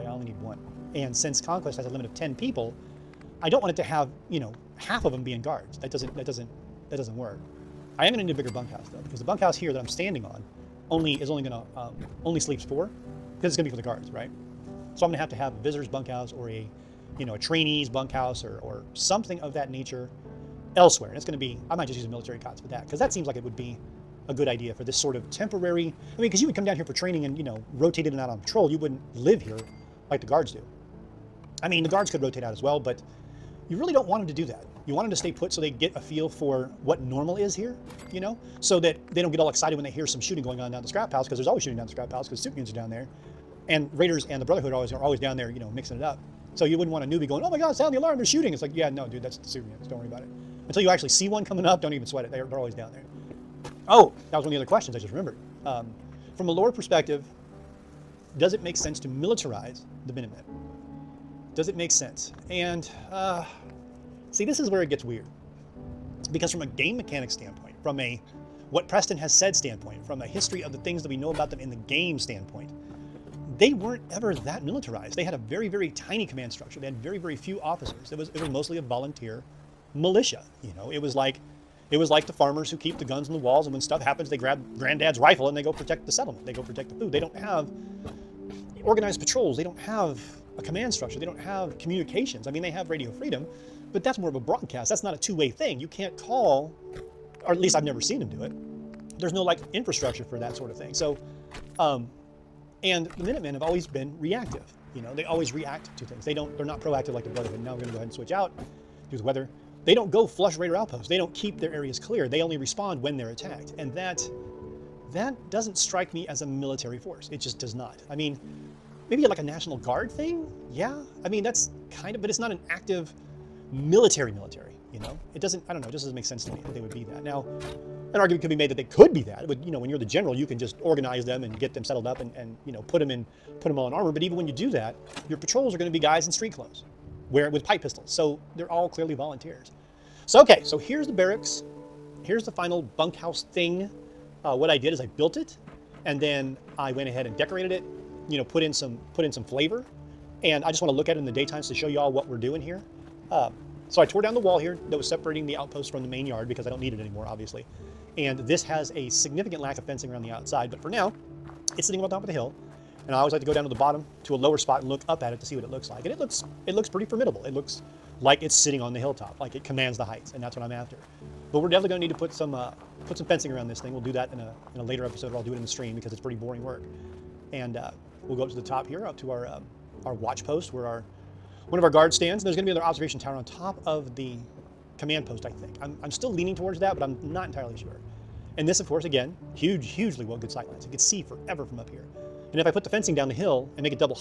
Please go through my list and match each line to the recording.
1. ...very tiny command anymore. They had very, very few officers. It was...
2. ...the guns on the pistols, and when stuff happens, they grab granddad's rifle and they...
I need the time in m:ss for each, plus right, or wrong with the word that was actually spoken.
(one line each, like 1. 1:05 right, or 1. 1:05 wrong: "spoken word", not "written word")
1. 1:15 wrong: "structure", not "anymore"
2. 1:22 wrong: "walls", not "pistols".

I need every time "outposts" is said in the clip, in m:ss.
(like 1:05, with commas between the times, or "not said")
1:50, 2:35.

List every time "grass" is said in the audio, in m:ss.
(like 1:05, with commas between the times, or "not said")
not said.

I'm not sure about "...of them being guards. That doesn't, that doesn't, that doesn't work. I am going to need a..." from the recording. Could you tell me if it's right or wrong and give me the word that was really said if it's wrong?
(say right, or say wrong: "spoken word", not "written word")
right.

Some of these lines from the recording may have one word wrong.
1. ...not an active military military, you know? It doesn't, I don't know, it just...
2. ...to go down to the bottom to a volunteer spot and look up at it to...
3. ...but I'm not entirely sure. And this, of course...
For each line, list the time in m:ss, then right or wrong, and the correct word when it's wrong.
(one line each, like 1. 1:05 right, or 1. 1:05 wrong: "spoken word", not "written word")
1. 2:02 right
2. 2:43 wrong: "lower", not "volunteer"
3. 3:06 right.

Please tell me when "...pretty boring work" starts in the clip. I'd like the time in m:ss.
2:56.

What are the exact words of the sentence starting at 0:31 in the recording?
I mean, the guards could rotate out as well, but you really don't want them to do that.